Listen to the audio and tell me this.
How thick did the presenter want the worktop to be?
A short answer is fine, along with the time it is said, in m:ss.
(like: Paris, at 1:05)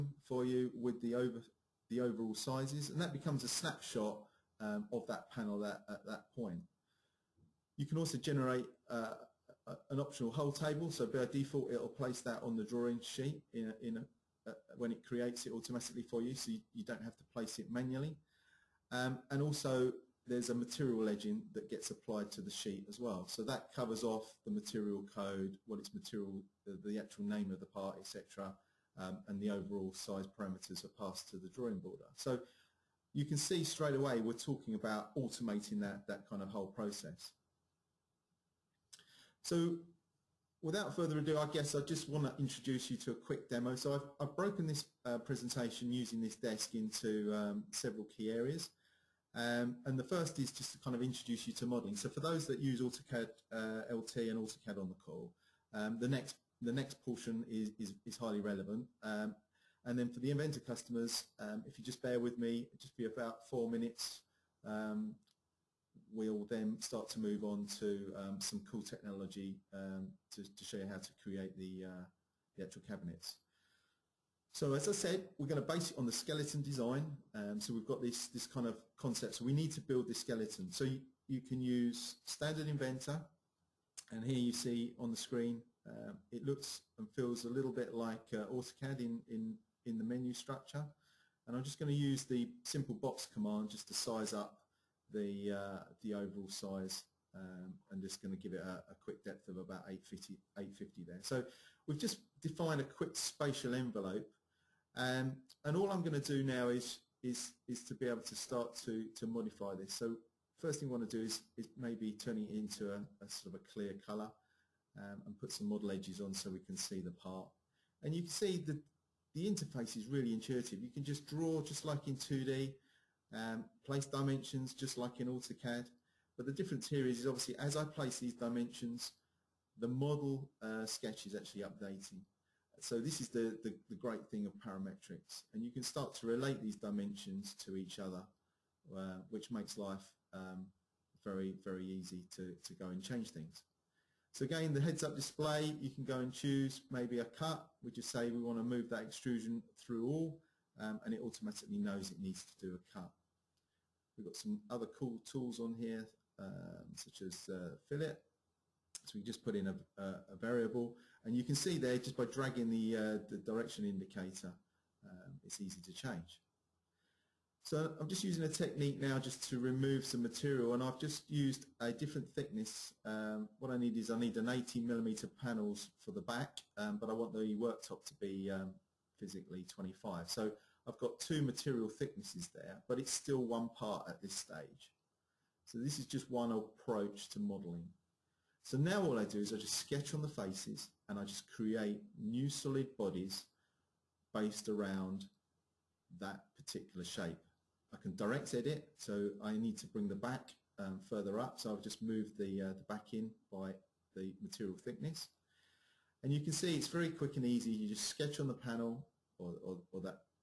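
25, at 2:59.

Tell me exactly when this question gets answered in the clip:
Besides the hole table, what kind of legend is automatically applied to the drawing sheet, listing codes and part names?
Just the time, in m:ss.
0:20.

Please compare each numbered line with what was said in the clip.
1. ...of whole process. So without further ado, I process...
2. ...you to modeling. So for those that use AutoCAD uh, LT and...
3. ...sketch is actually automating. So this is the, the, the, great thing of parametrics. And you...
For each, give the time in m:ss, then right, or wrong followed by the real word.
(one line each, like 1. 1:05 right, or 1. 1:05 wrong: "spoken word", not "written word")
1. 0:36 wrong: "guess", not "process"
2. 0:51 right
3. 2:10 wrong: "updating", not "automating".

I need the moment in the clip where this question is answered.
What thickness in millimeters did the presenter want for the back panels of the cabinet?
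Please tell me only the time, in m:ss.
2:54.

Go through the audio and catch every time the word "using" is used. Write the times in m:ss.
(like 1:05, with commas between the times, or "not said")
0:45, 2:48.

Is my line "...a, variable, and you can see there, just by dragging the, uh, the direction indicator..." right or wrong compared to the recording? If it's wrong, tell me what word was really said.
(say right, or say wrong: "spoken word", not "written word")
right.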